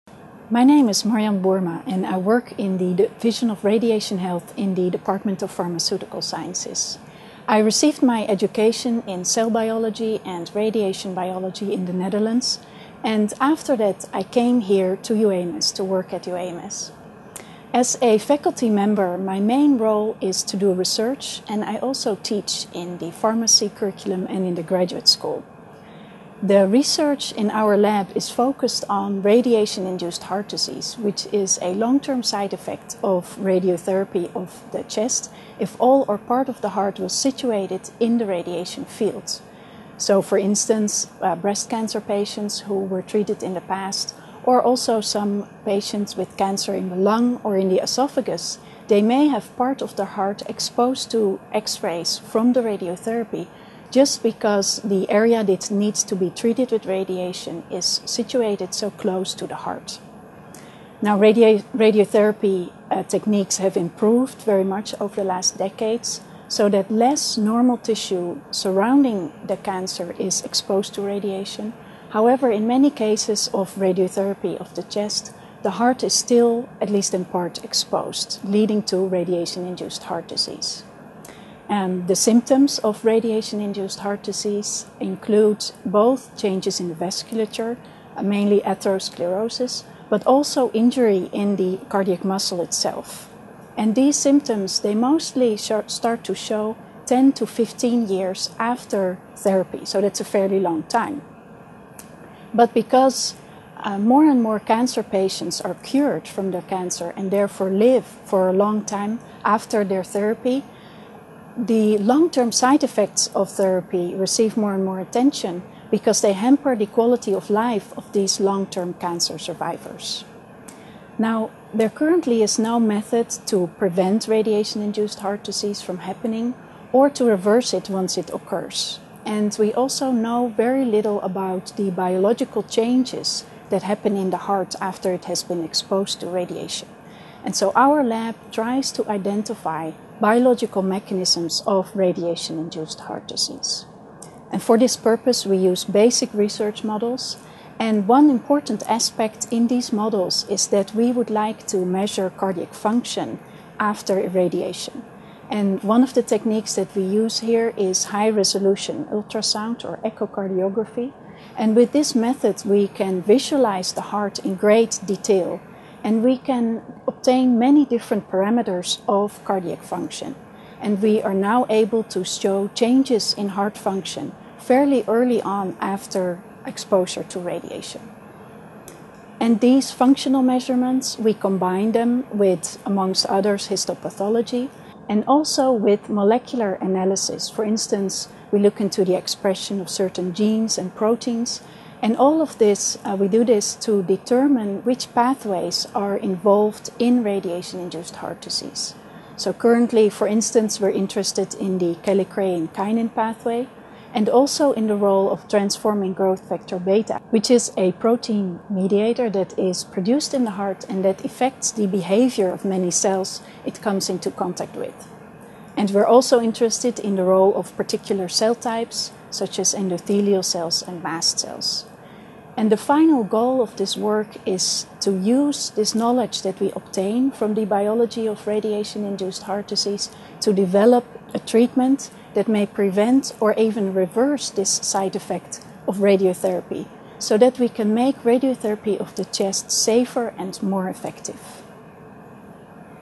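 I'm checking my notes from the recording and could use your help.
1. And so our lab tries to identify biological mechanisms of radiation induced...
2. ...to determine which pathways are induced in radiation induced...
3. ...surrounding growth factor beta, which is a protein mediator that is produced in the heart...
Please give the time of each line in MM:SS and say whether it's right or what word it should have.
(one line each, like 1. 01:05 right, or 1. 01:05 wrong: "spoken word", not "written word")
1. 02:17 right
2. 03:13 wrong: "involved", not "induced"
3. 03:25 wrong: "transforming", not "surrounding".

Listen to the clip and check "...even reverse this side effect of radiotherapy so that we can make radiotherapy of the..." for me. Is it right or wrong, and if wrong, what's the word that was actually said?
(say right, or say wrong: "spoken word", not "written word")
right.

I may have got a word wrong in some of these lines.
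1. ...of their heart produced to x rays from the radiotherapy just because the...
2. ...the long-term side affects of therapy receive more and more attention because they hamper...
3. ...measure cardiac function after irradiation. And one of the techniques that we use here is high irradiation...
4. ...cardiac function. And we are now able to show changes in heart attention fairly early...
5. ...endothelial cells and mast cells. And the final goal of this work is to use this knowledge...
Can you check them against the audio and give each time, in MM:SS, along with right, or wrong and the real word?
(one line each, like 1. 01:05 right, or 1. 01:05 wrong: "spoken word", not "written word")
1. 00:49 wrong: "exposed", not "produced"
2. 01:51 wrong: "effects", not "affects"
3. 02:31 wrong: "resolution", not "irradiation"
4. 02:49 wrong: "function", not "attention"
5. 03:39 right.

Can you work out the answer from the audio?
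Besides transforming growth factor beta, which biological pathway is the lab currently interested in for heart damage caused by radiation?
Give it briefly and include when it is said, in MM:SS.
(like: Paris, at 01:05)
kallikrein kinin pathway, at 03:22.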